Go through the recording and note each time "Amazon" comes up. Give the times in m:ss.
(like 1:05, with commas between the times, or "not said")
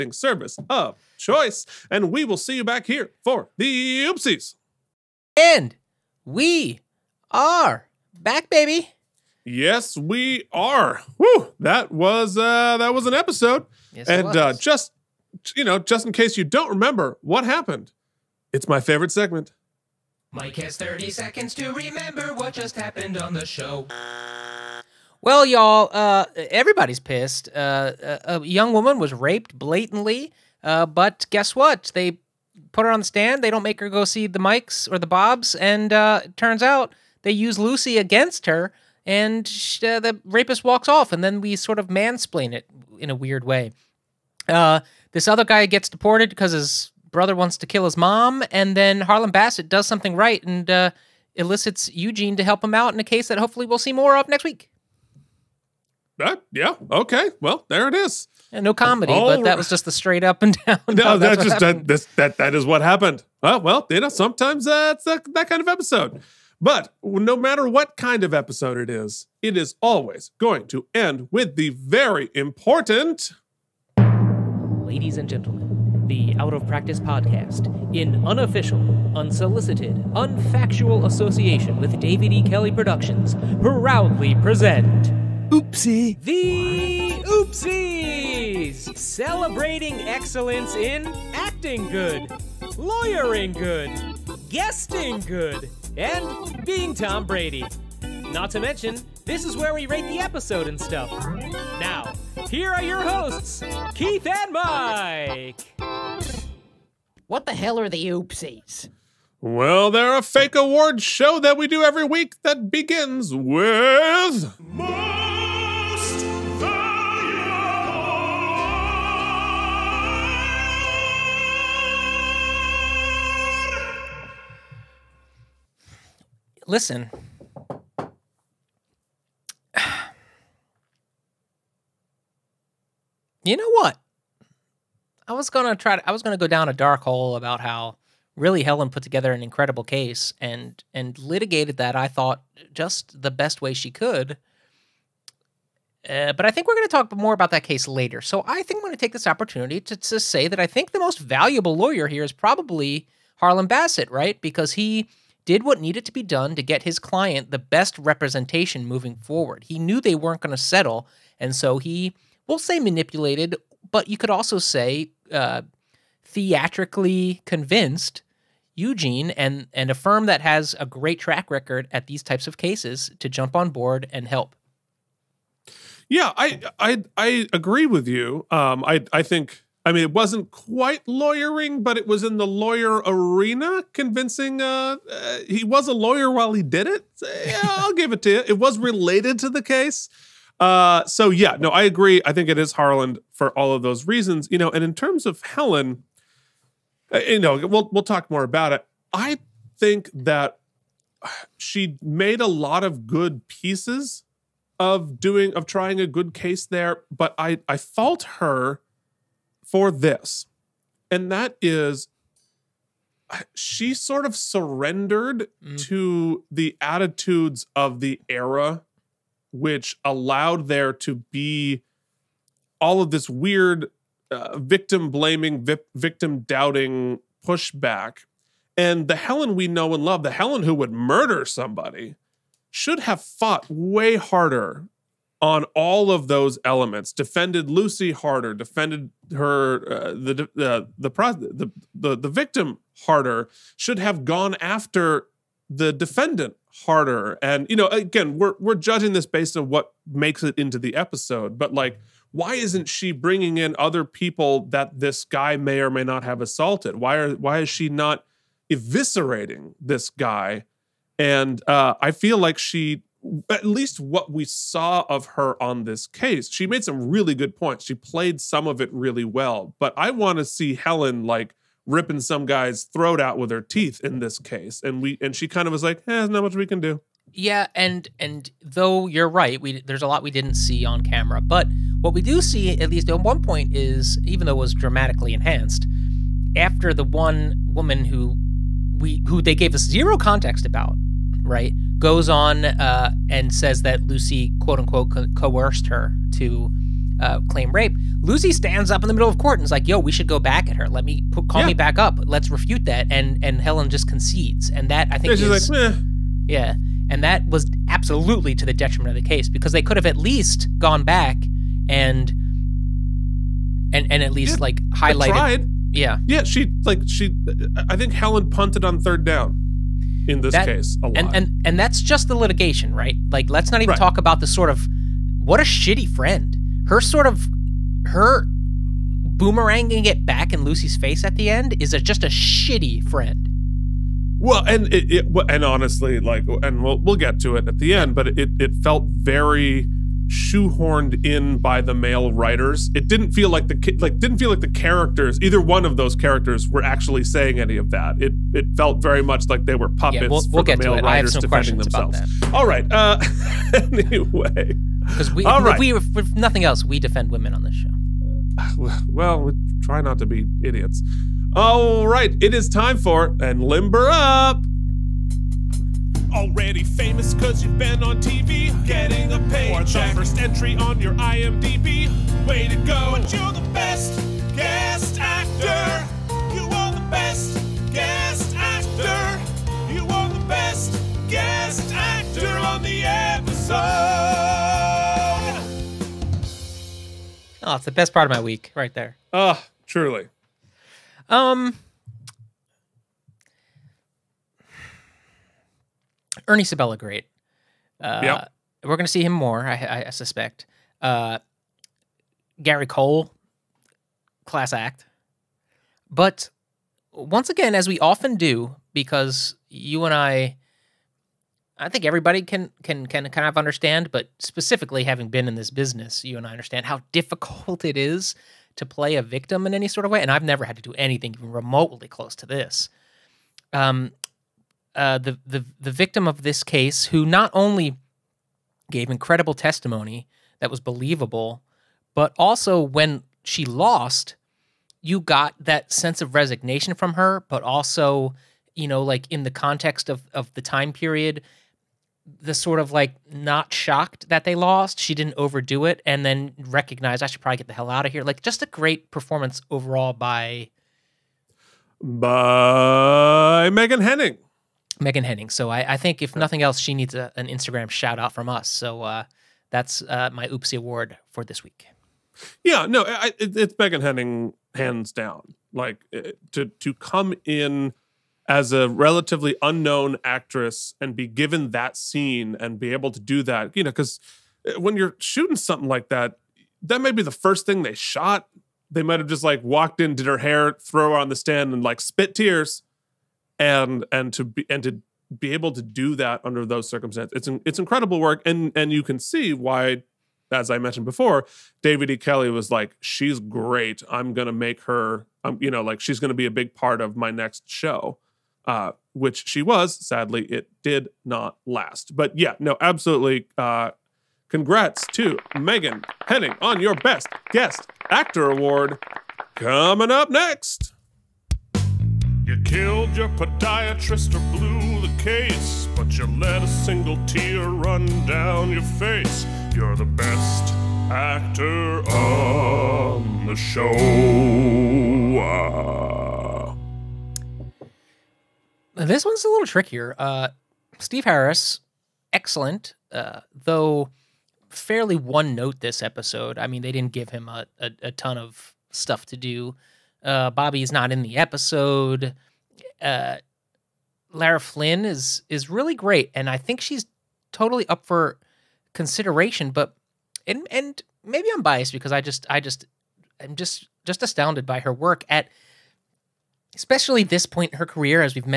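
not said.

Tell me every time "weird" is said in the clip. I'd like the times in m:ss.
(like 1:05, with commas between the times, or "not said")
0:43, 3:43.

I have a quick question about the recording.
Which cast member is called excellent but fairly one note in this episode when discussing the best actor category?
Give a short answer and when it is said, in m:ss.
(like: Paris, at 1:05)
Steve Harris, at 8:50.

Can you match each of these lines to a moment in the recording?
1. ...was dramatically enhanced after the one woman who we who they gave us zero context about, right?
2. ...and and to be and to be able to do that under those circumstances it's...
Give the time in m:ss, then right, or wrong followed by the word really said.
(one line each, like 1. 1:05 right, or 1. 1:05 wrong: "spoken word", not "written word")
1. 4:44 right
2. 8:03 right.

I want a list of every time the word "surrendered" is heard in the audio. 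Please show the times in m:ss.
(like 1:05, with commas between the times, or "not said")
3:34.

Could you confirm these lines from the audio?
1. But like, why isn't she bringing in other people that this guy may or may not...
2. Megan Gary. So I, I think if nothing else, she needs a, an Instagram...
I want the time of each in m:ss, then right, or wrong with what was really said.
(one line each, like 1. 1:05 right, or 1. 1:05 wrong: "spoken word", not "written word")
1. 4:11 right
2. 7:34 wrong: "Henning", not "Gary".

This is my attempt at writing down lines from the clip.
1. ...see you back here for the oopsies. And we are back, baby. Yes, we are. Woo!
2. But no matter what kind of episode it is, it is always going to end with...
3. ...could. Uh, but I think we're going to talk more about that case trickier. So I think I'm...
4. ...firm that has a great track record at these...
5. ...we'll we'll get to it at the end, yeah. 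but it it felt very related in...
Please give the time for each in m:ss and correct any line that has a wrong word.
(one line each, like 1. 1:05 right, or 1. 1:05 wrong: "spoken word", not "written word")
1. 0:02 right
2. 1:06 right
3. 2:23 wrong: "later", not "trickier"
4. 2:49 right
5. 5:36 wrong: "shoehorned", not "related".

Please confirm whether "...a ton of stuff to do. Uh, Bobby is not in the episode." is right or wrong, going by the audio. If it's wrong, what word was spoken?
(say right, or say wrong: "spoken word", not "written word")
right.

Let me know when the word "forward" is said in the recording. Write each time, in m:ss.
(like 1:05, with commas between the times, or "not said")
2:39.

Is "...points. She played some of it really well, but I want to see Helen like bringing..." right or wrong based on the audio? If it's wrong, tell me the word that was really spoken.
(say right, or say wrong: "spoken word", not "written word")
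wrong: "ripping", not "bringing".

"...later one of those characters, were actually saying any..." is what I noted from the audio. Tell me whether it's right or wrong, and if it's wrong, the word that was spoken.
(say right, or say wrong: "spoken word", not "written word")
wrong: "either", not "later".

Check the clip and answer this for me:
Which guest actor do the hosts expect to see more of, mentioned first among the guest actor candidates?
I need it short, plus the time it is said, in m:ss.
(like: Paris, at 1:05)
Ernie Sabella, at 6:36.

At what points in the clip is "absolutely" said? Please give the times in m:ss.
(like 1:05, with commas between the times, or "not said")
5:07, 8:22.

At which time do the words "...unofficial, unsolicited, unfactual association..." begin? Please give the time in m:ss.
1:18.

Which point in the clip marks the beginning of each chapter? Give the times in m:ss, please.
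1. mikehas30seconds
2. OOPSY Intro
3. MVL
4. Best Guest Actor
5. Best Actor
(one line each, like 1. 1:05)
1. 0:09
2. 1:12
3. 1:54
4. 6:04
5. 8:30.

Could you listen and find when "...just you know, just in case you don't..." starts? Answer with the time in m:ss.
0:14.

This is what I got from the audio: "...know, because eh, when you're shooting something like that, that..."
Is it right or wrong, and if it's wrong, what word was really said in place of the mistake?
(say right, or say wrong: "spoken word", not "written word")
right.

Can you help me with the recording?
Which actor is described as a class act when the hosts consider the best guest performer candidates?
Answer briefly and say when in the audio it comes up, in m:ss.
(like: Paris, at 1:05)
Gary Cole, at 6:42.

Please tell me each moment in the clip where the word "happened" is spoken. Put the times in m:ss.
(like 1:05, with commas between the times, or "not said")
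0:17, 0:22, 1:02.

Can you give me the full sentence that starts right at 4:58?
Lucy stands up in the middle of court and is like, "Yo, we should go back at her.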